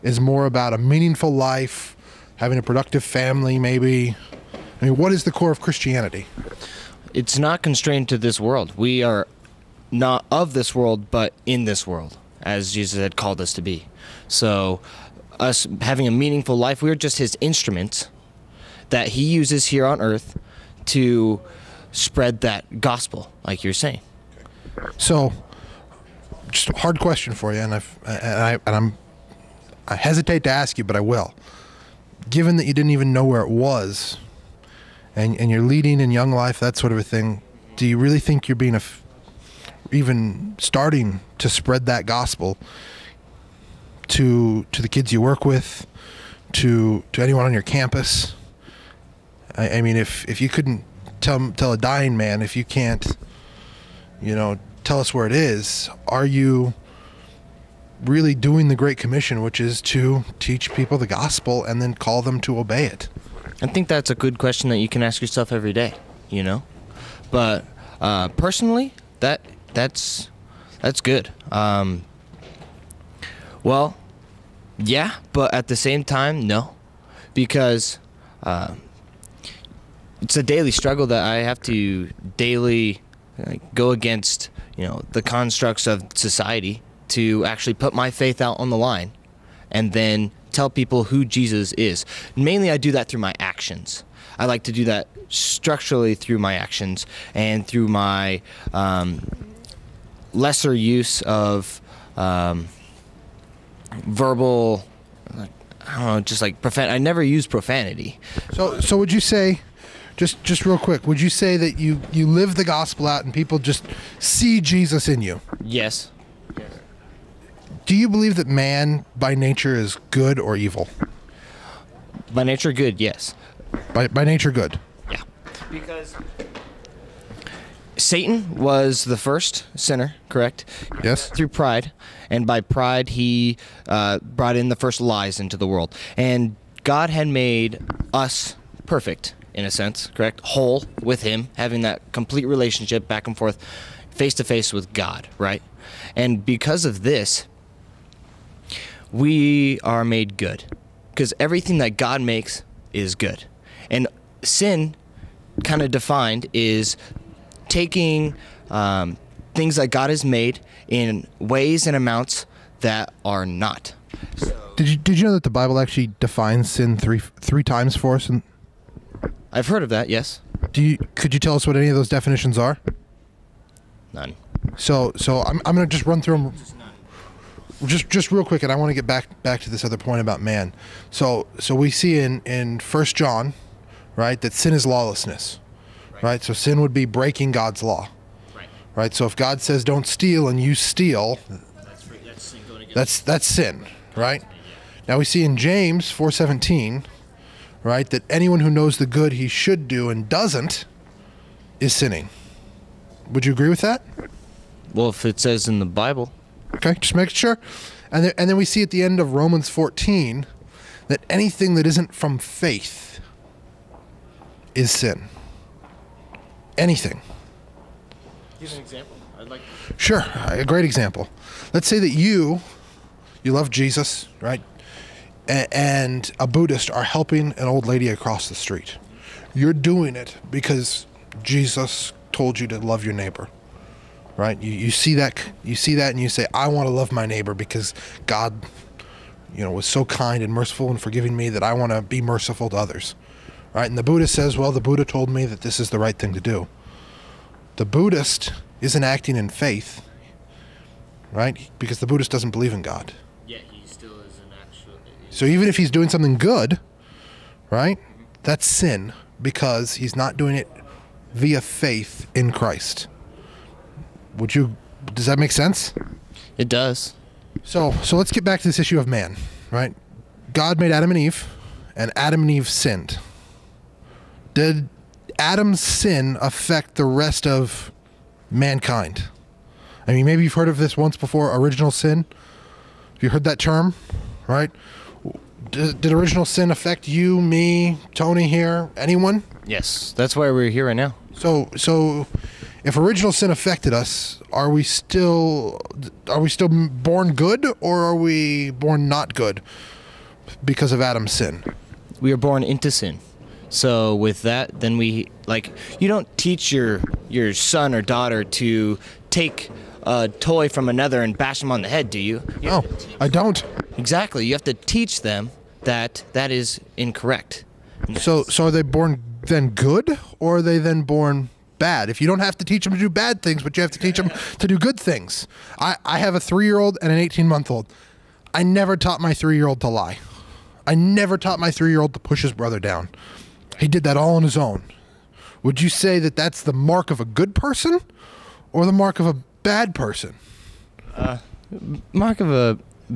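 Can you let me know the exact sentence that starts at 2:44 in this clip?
So, did you did you know that the Bible actually defines sin three three times for us?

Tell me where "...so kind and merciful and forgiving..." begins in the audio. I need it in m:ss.
3:59.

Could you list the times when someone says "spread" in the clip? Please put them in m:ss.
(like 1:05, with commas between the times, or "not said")
0:21, 0:41.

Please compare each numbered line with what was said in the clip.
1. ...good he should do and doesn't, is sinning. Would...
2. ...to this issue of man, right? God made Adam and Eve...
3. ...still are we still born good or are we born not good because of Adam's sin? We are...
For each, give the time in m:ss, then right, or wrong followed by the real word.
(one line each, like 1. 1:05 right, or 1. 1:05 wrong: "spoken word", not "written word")
1. 3:19 right
2. 4:28 right
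3. 4:54 right.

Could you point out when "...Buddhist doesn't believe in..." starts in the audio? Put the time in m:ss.
4:12.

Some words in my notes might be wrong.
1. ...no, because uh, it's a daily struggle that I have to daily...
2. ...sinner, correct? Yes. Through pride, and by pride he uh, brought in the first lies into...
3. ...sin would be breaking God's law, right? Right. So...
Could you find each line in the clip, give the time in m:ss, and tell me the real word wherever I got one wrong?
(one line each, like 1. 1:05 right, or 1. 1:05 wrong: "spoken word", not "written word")
1. 1:16 right
2. 2:09 right
3. 3:06 right.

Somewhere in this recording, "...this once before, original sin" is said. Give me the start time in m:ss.
4:40.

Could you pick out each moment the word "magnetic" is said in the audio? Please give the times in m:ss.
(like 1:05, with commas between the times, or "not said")
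not said.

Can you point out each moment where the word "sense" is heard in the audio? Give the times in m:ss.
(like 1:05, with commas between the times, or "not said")
2:19, 4:25.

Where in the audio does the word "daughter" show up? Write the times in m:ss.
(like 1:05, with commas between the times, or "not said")
5:08.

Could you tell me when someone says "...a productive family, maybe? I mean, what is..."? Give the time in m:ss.
0:02.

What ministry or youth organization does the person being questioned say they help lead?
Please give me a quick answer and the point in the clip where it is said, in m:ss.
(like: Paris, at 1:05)
Young Life, at 0:36.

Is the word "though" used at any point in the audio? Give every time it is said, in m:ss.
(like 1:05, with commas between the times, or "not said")
not said.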